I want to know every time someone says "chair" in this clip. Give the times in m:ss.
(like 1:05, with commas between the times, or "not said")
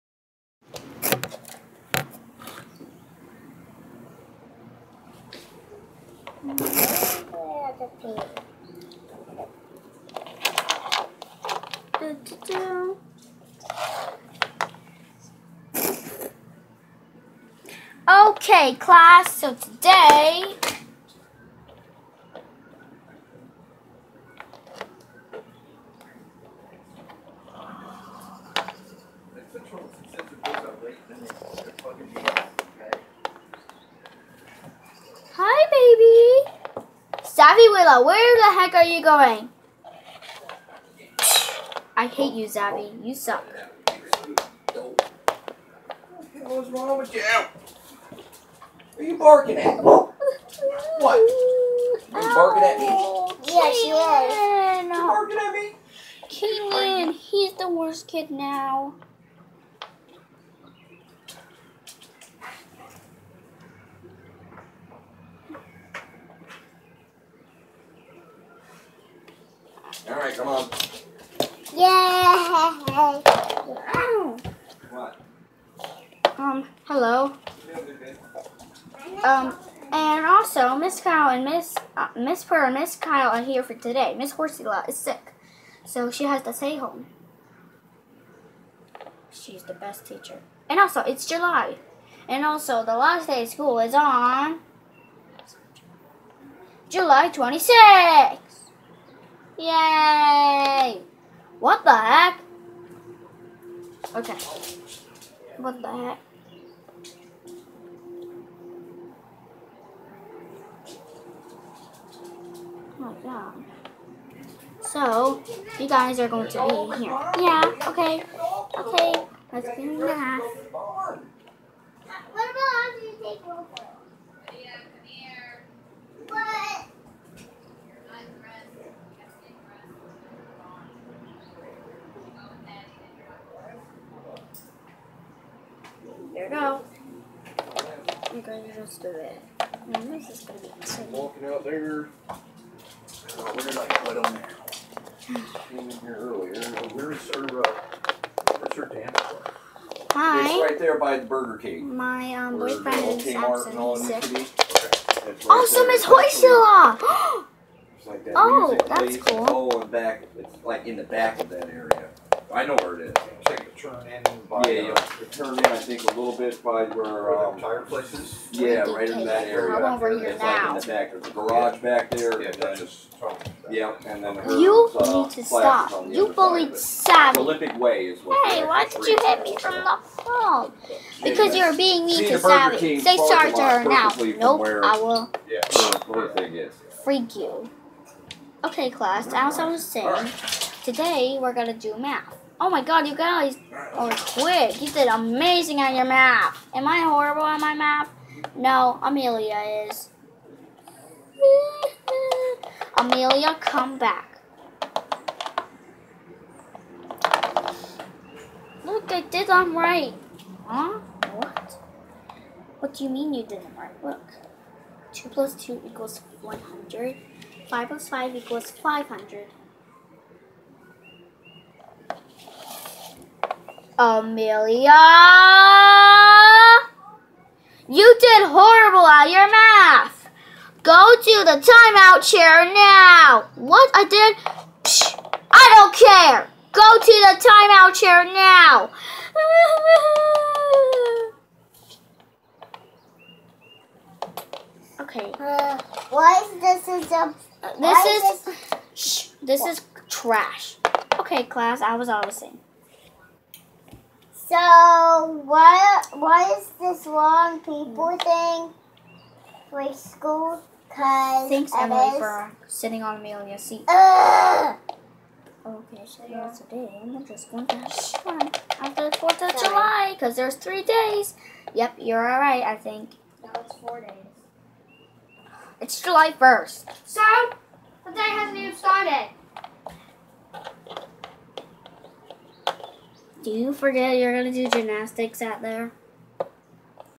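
3:52, 3:57.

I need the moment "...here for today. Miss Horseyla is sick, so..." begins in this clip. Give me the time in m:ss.
1:23.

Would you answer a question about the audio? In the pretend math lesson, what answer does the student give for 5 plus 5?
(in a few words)
500.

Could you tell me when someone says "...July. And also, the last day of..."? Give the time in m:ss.
1:31.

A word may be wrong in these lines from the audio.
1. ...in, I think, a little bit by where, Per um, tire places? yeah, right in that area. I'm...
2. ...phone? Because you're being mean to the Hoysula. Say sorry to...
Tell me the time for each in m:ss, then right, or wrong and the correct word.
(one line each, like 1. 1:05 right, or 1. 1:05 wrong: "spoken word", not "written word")
1. 2:45 wrong: "Where", not "Per"
2. 3:00 wrong: "Sammy", not "Hoysula".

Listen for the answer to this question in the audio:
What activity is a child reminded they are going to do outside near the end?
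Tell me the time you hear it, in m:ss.
4:44.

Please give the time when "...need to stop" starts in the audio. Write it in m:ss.
2:55.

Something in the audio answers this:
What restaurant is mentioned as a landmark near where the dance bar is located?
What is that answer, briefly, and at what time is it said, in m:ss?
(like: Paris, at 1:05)
Burger King, at 2:31.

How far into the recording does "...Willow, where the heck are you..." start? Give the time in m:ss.
0:37.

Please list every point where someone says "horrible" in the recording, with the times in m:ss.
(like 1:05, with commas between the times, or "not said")
3:16, 3:48.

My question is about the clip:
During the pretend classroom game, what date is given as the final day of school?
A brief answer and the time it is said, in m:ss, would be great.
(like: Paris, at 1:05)
July 26th, at 1:36.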